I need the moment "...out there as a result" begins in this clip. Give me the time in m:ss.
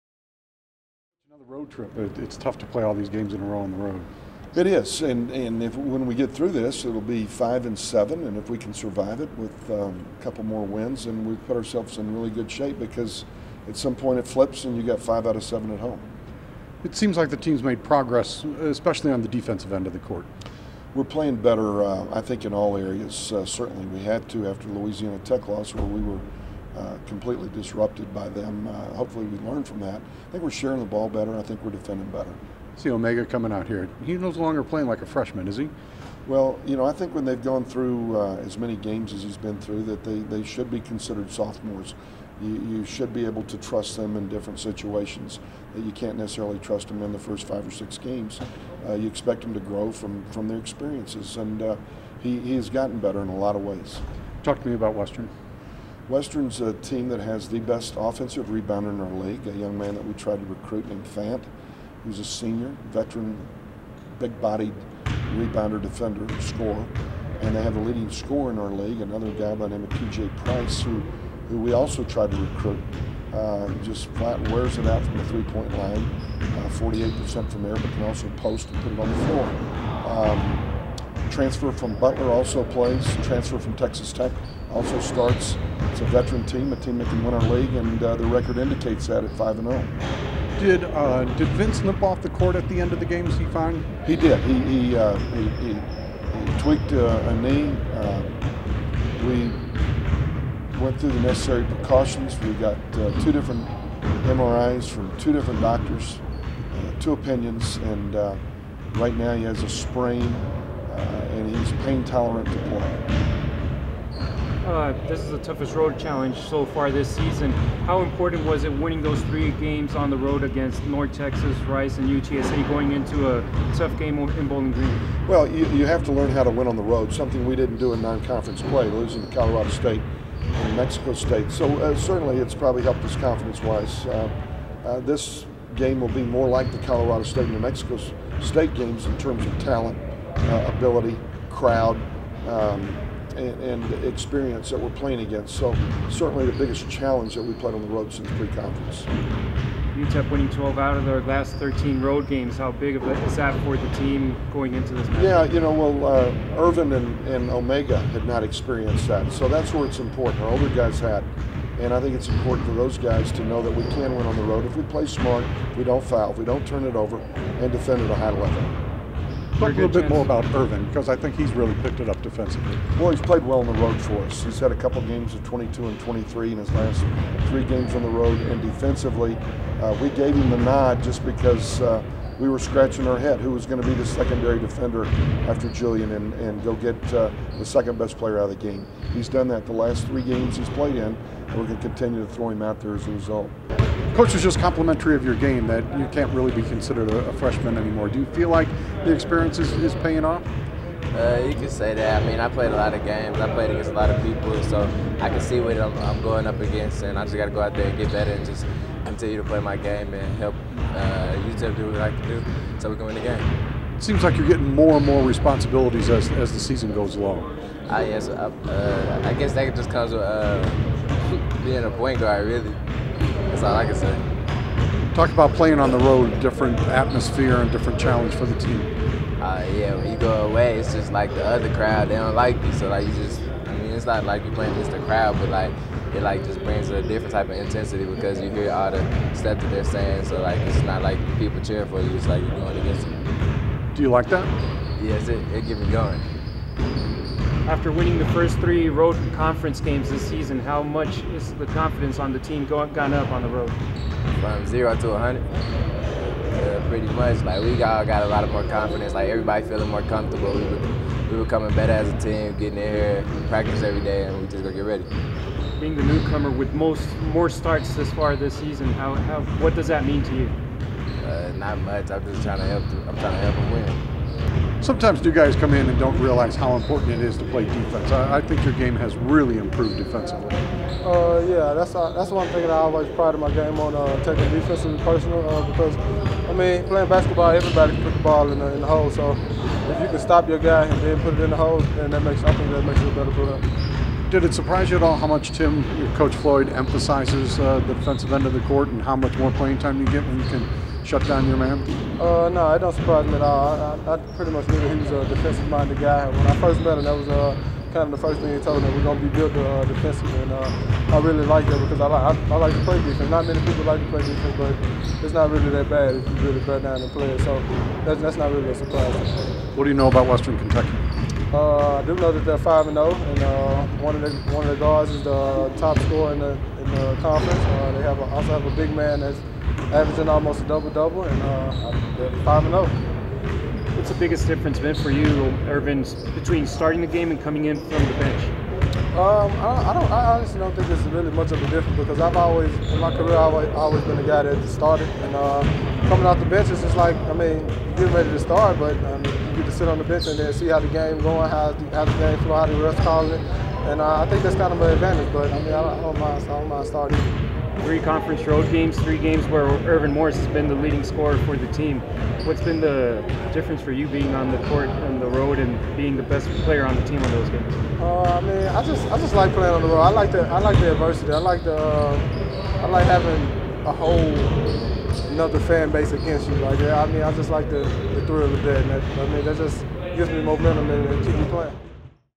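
3:12.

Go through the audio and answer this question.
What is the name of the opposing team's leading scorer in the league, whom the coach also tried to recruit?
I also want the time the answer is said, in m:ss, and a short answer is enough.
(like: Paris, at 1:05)
TJ Price, at 1:09.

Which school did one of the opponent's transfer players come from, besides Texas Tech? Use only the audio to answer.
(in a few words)
Butler.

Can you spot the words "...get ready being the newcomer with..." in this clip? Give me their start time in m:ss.
4:24.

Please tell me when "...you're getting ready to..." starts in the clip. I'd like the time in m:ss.
5:47.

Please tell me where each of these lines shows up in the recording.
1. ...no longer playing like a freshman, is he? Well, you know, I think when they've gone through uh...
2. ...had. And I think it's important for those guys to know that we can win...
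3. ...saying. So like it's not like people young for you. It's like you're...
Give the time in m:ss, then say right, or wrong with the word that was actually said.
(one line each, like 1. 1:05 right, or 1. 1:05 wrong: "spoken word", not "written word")
1. 0:34 right
2. 2:40 right
3. 3:59 wrong: "cheering", not "young".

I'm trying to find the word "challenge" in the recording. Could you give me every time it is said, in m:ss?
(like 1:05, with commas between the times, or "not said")
1:55, 2:26, 3:47.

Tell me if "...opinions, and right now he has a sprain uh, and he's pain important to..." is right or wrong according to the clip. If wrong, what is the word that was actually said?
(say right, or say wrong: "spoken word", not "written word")
wrong: "tolerant", not "important".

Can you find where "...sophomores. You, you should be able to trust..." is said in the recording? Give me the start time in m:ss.
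0:41.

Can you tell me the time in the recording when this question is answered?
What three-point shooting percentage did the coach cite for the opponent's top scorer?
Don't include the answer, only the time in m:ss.
1:16.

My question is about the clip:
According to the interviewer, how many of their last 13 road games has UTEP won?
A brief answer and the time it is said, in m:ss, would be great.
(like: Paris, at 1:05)
12, at 2:30.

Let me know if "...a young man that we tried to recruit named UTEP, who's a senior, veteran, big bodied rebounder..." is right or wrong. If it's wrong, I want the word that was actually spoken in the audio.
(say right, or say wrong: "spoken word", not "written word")
wrong: "Fant", not "UTEP".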